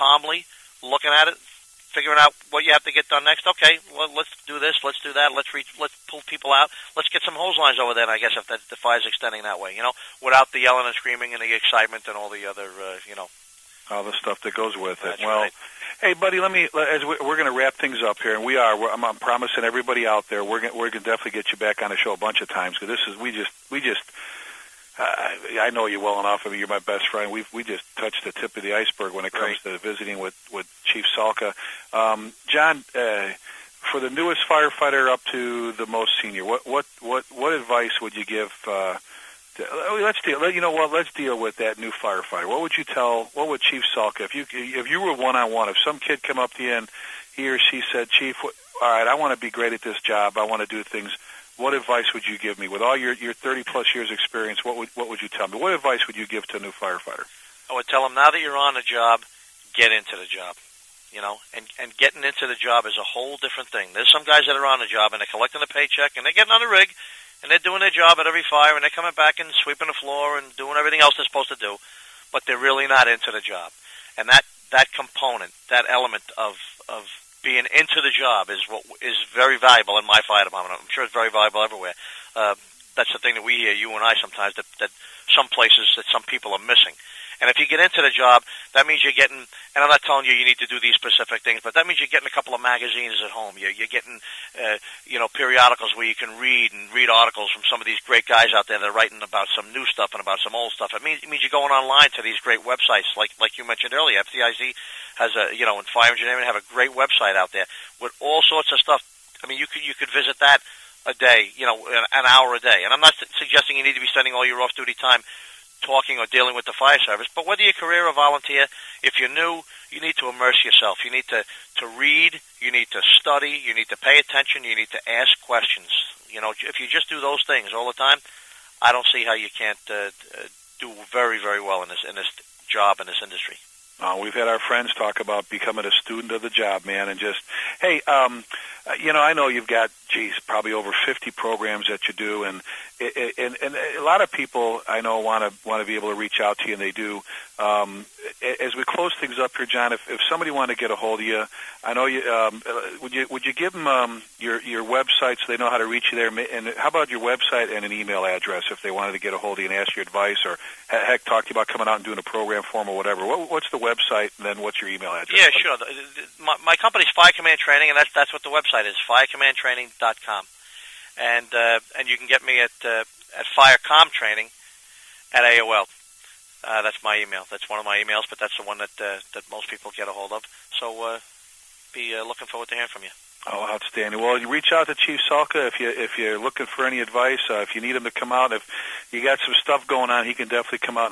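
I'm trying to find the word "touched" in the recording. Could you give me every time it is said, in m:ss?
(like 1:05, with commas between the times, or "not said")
0:27.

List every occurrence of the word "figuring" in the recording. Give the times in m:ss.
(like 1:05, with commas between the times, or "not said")
0:01.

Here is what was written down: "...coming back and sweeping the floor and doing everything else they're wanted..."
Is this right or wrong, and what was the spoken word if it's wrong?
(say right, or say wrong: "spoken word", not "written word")
wrong: "supposed", not "wanted".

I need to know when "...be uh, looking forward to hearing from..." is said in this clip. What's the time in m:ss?
3:01.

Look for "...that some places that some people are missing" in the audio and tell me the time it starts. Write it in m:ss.
1:24.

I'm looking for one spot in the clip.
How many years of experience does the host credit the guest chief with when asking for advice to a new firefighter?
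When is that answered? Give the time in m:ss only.
0:53.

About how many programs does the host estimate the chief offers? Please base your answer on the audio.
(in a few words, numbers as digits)
over 50.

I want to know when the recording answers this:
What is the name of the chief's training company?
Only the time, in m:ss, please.
2:47.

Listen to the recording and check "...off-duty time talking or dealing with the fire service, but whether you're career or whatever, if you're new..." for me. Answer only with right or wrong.
wrong.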